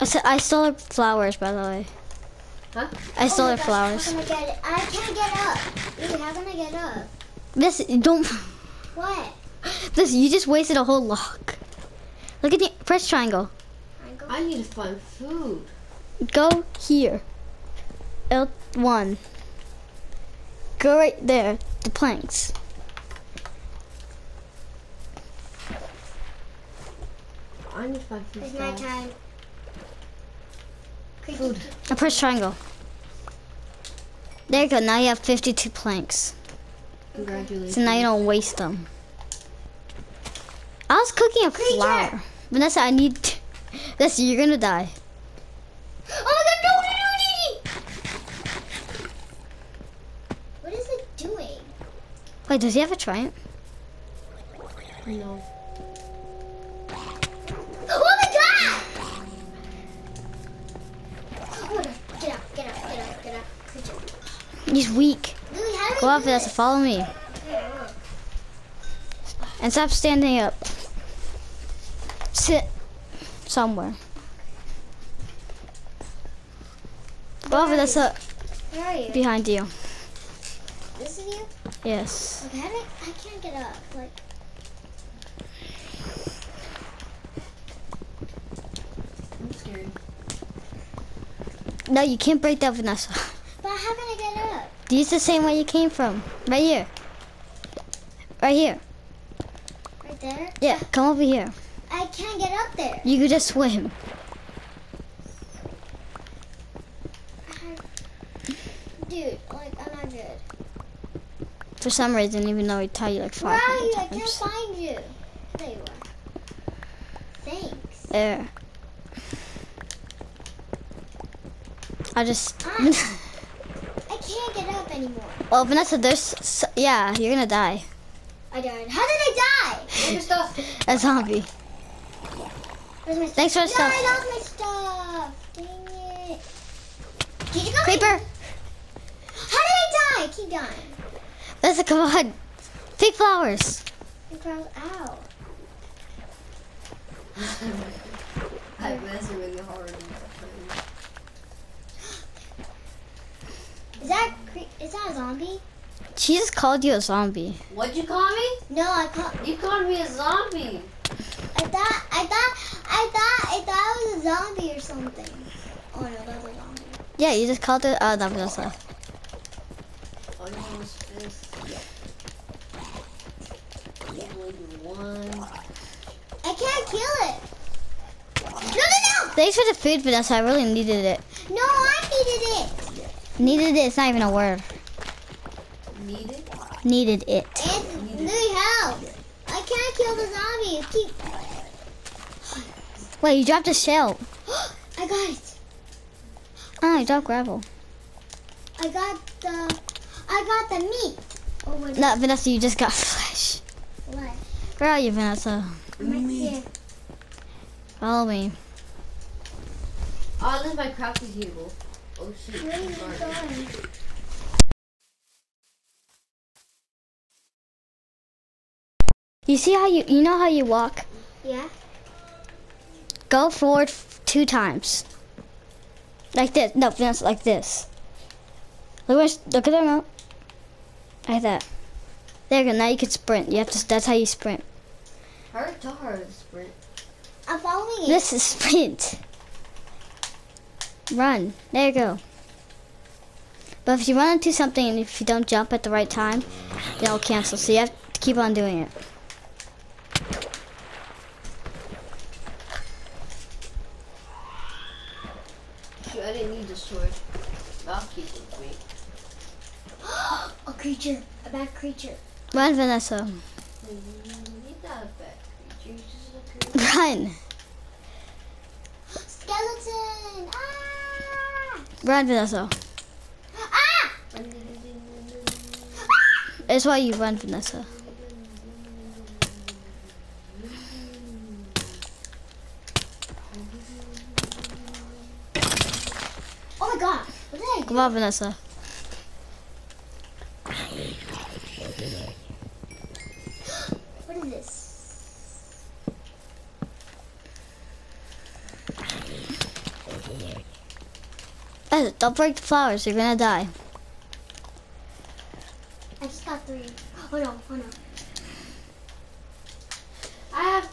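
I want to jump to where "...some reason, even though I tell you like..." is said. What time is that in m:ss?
1:51.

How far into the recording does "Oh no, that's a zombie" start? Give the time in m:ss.
2:45.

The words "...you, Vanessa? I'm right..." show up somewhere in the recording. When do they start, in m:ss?
3:24.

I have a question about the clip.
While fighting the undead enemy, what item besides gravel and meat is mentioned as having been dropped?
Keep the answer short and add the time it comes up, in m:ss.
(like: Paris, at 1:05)
a shell, at 3:13.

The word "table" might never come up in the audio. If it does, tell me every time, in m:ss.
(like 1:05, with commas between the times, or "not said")
3:31.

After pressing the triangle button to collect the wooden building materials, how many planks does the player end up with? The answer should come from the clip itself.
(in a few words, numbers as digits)
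52.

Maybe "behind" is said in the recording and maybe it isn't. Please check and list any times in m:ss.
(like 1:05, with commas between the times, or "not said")
1:19.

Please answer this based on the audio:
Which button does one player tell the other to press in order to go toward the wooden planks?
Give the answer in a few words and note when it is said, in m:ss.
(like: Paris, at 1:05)
L1, at 0:18.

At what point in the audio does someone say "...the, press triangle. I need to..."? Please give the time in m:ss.
0:12.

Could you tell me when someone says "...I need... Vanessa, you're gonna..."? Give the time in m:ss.
0:42.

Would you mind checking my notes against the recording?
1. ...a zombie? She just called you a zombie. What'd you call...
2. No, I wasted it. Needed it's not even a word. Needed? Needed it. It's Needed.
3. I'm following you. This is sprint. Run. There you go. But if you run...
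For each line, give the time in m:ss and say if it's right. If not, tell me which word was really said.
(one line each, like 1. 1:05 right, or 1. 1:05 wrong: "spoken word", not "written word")
1. 2:35 right
2. 3:01 wrong: "needed", not "wasted"
3. 3:57 right.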